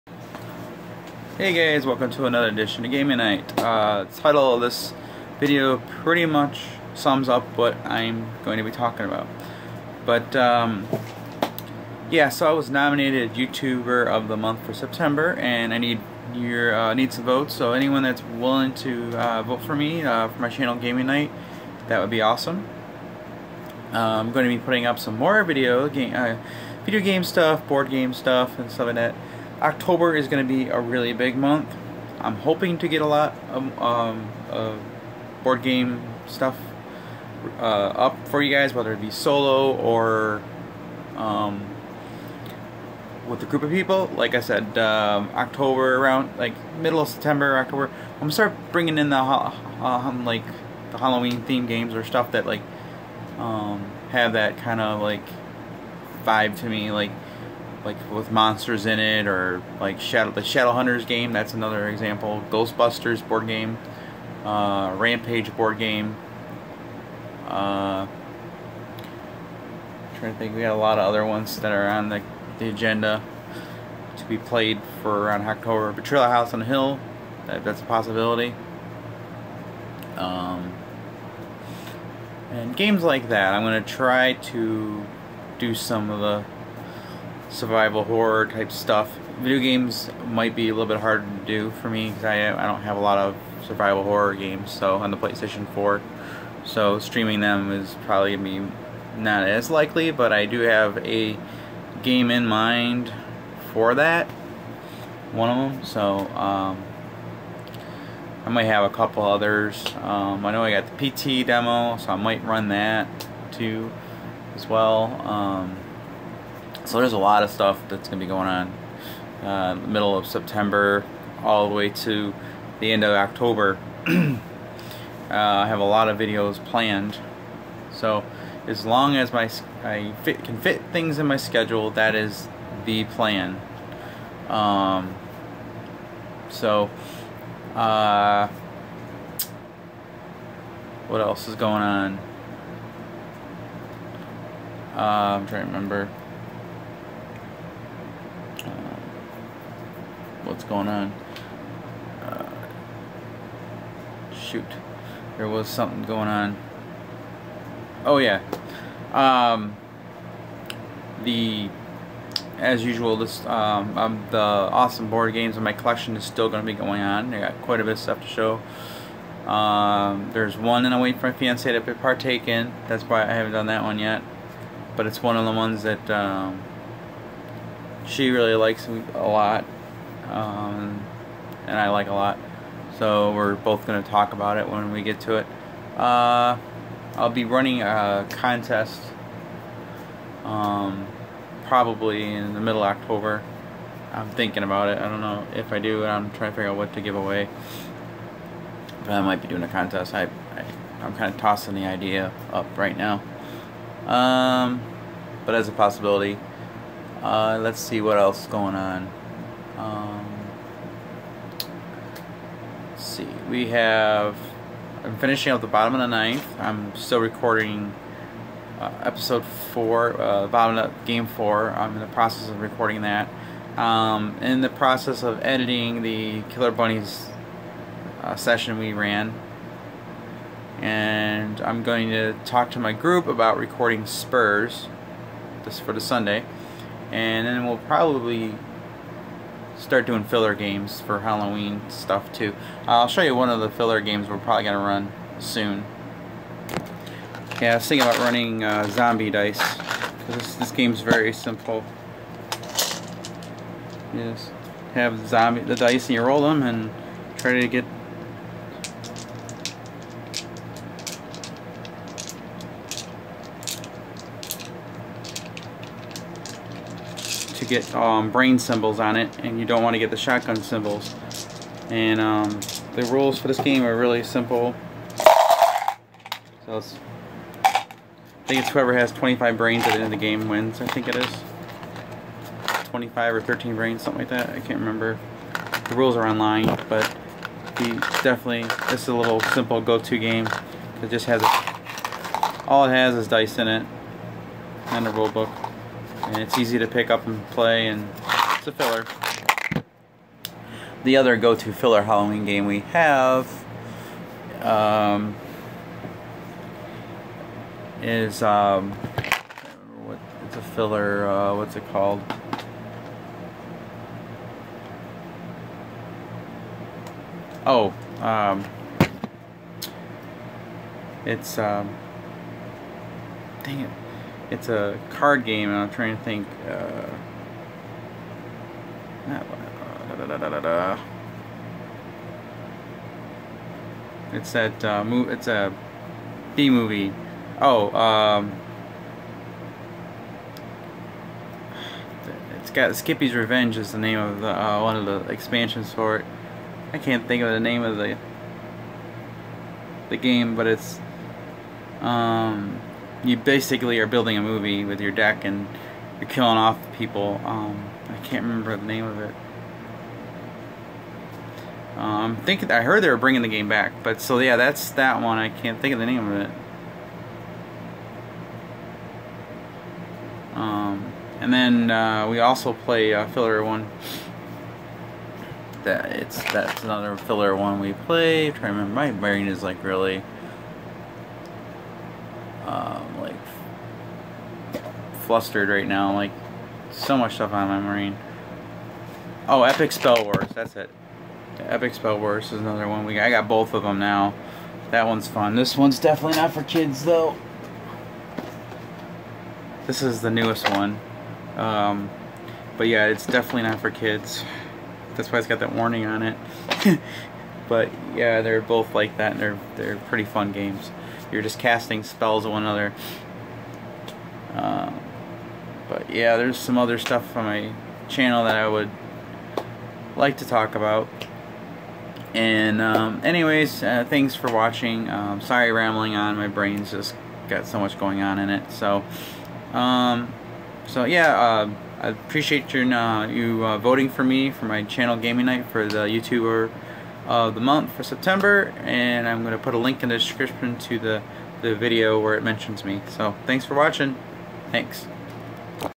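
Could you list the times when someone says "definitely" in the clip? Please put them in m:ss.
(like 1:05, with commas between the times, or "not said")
4:48, 6:35, 6:43.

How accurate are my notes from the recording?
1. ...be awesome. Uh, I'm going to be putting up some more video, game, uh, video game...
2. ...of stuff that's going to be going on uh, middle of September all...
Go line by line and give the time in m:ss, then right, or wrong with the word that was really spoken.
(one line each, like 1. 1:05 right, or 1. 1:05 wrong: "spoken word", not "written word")
1. 0:22 right
2. 1:57 right.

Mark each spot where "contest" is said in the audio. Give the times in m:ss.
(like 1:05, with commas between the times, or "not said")
3:08, 3:19.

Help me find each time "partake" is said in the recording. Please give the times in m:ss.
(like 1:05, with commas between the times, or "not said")
2:51.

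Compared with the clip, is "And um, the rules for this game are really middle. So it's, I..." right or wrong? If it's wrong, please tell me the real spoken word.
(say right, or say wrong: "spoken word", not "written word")
wrong: "simple", not "middle".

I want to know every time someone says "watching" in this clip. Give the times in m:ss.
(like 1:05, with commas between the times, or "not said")
7:04, 7:23.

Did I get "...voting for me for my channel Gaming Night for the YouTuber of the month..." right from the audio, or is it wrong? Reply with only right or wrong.
right.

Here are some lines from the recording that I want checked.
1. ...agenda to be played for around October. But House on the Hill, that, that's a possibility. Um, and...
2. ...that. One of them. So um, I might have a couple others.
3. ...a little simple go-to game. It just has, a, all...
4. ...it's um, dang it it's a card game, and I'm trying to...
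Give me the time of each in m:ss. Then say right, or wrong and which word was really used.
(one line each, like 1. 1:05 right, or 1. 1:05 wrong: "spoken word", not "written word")
1. 1:12 right
2. 1:43 right
3. 4:49 right
4. 5:21 right.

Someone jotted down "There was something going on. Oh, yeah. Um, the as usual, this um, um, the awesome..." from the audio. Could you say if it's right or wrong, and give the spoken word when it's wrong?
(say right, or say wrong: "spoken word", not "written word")
right.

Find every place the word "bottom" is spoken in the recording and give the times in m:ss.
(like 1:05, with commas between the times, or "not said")
3:35, 3:40.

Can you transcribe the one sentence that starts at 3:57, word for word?
And then we'll probably start doing filler games for Halloween stuff too.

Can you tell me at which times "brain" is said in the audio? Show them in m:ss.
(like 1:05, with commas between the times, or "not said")
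4:28, 4:39, 4:43, 6:19, 7:06.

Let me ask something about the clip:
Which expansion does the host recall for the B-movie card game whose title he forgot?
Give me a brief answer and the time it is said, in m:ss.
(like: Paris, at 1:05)
Skippy's Revenge, at 5:42.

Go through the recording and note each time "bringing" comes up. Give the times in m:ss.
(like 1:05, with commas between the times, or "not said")
0:48, 6:03.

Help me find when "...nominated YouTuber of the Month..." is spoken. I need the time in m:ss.
0:12.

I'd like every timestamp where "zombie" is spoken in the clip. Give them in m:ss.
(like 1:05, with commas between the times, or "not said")
4:08, 4:15.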